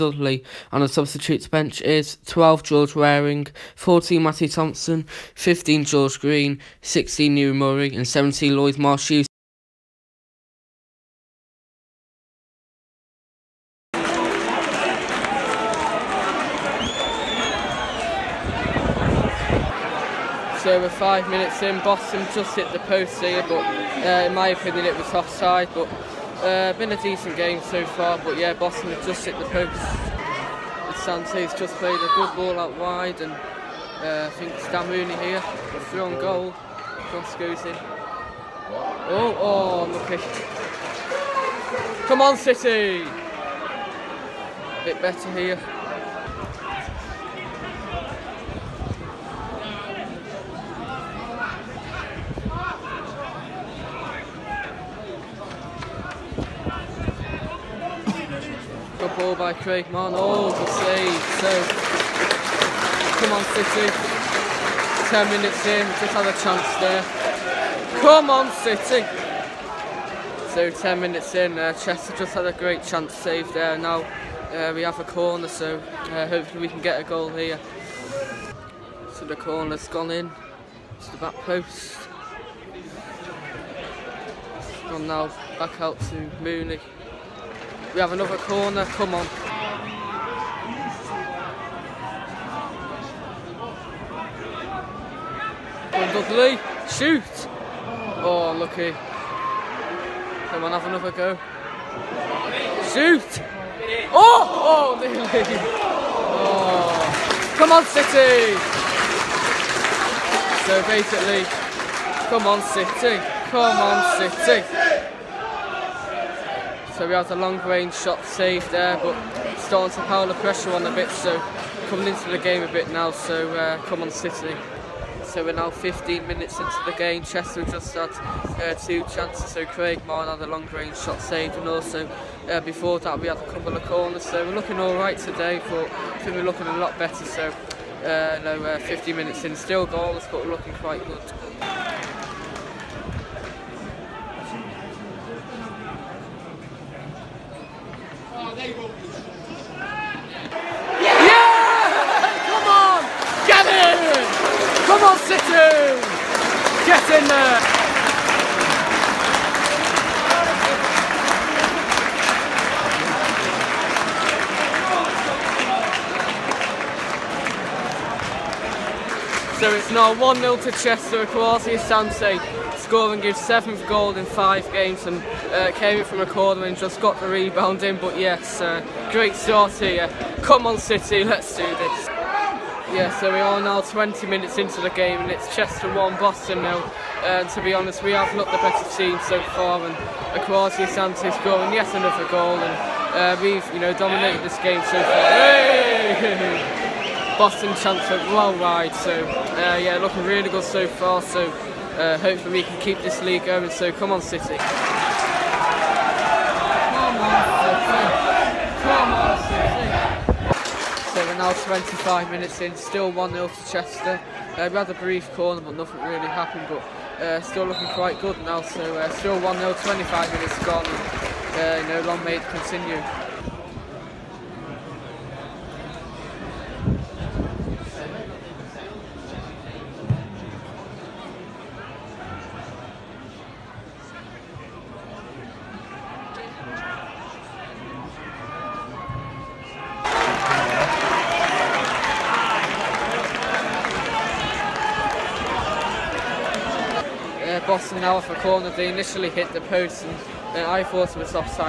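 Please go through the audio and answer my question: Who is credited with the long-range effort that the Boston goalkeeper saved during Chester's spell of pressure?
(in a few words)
Craig Martin.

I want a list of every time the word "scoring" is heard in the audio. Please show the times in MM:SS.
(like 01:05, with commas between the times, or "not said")
02:52, 03:11.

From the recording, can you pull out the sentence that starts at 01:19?
So, the corner's gone in to the back post.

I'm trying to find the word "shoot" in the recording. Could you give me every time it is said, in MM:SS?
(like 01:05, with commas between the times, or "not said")
01:36, 01:42.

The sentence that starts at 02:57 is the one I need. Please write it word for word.
But yes, uh, great start here.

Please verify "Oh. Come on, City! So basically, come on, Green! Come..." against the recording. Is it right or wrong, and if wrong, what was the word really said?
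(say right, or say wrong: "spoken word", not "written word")
wrong: "City", not "Green".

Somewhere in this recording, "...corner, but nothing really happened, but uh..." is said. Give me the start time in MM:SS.
03:35.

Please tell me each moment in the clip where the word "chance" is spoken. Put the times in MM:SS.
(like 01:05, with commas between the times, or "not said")
01:06, 01:12, 02:09, 03:17.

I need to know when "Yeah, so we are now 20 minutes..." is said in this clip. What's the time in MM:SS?
03:02.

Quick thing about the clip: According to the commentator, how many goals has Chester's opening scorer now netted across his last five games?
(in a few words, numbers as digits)
7.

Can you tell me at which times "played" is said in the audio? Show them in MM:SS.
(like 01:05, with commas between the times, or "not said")
00:31.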